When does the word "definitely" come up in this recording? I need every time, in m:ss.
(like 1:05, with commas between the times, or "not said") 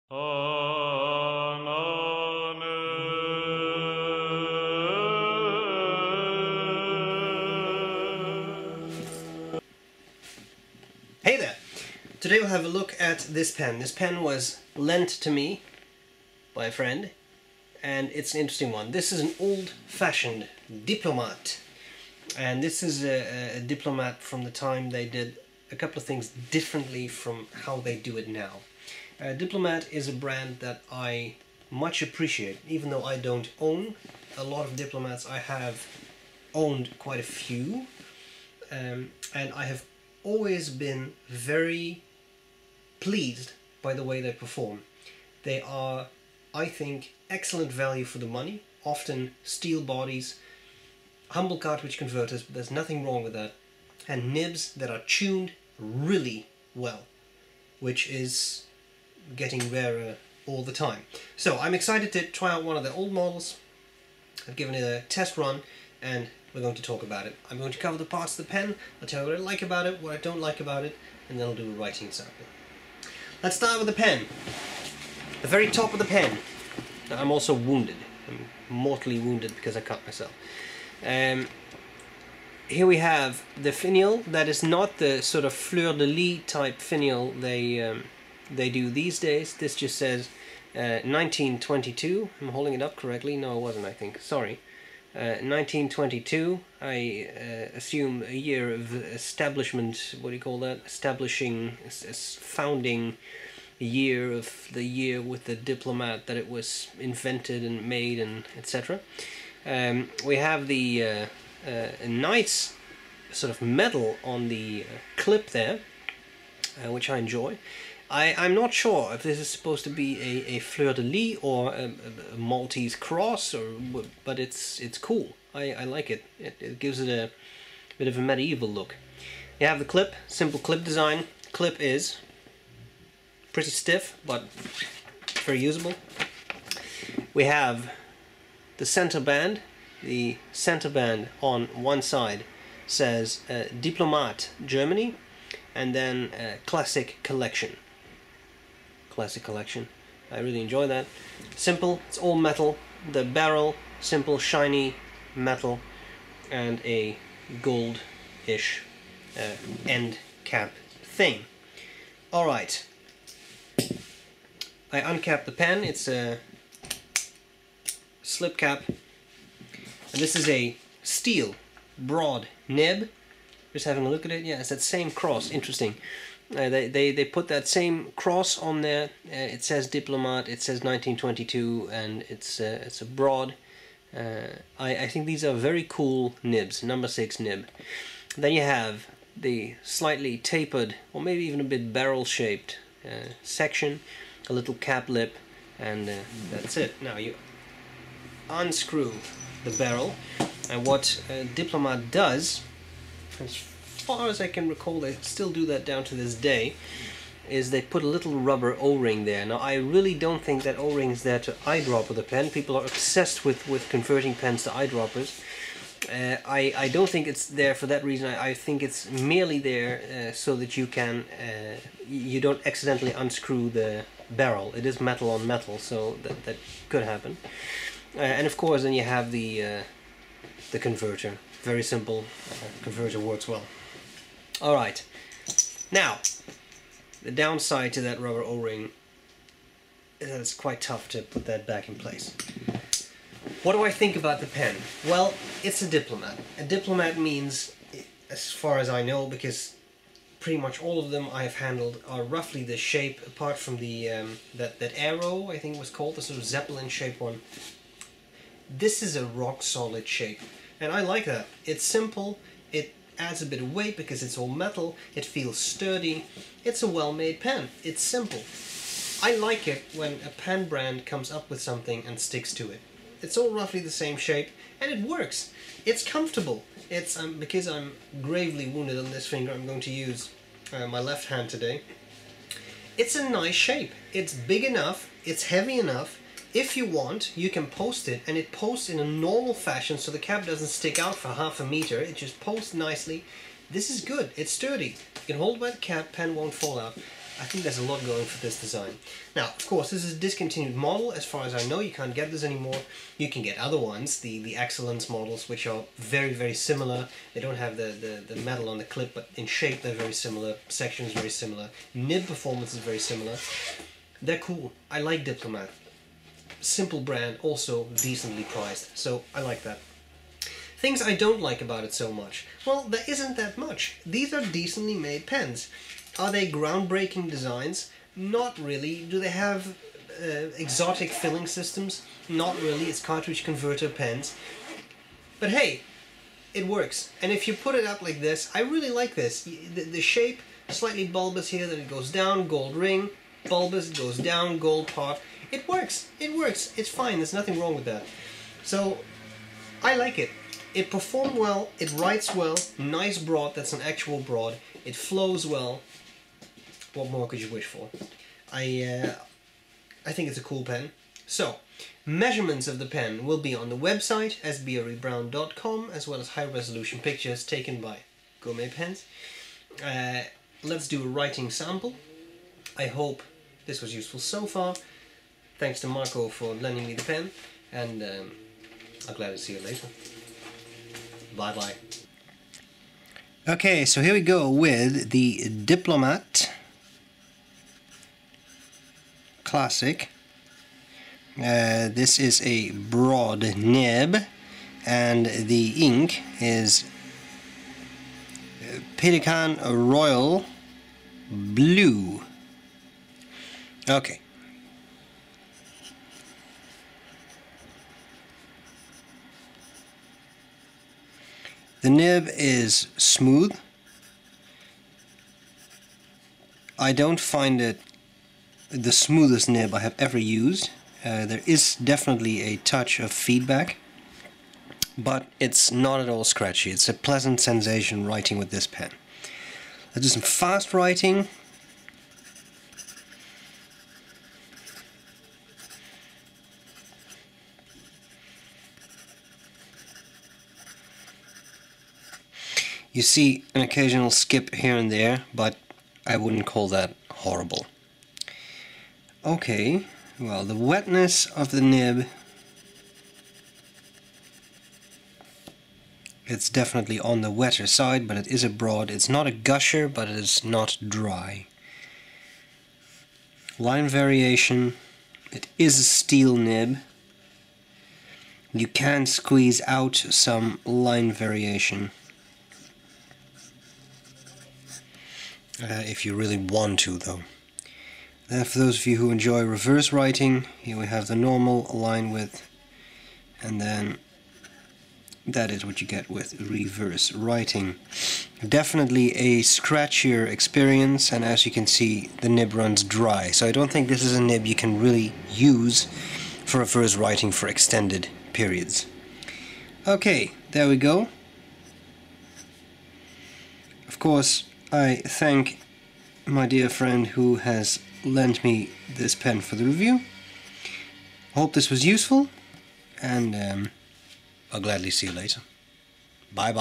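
7:01, 7:36, 8:08.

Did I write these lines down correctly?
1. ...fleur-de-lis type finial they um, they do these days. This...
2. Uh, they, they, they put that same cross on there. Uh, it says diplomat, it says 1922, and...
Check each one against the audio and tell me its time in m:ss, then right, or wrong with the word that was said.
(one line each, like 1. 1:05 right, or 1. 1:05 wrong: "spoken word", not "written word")
1. 1:25 right
2. 2:56 right.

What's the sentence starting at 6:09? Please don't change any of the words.
Uh, let's do a writing sample.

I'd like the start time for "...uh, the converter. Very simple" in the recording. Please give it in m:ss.
3:49.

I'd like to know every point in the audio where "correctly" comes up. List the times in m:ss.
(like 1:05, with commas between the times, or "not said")
1:32.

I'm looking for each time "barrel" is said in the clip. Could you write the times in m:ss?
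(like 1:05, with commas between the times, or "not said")
2:33, 3:11, 3:19, 3:44.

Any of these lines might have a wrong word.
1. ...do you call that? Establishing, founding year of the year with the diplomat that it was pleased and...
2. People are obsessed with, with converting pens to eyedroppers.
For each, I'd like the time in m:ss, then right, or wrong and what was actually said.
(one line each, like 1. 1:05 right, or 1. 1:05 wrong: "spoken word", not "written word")
1. 1:40 wrong: "invented", not "pleased"
2. 3:32 right.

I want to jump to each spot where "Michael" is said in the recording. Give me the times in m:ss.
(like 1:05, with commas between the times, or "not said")
6:15.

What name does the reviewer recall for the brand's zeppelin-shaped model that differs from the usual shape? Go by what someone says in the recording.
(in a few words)
Aero.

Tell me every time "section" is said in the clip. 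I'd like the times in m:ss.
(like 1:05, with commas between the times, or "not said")
3:13, 5:10.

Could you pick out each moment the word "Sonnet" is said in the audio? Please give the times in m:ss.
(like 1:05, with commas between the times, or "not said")
not said.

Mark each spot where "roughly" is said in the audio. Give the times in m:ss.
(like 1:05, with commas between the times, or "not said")
4:12, 4:33.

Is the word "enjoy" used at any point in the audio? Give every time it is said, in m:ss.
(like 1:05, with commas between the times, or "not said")
1:57, 2:30, 7:59.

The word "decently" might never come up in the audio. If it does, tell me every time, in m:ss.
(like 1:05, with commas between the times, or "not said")
5:17, 5:24.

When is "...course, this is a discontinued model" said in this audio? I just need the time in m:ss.
4:59.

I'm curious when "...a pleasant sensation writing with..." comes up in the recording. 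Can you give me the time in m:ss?
7:06.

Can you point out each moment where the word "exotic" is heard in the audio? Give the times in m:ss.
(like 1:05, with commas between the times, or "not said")
5:30.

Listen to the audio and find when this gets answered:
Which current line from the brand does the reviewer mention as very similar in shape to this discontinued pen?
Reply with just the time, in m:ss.
5:04.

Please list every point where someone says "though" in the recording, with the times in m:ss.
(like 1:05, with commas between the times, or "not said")
0:32, 7:56.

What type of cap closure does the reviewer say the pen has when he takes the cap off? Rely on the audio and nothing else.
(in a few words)
Slip cap.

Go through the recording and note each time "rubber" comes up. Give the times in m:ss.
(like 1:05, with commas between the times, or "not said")
3:28, 3:58.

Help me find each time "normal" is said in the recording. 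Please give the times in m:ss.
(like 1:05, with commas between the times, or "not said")
4:49, 8:01.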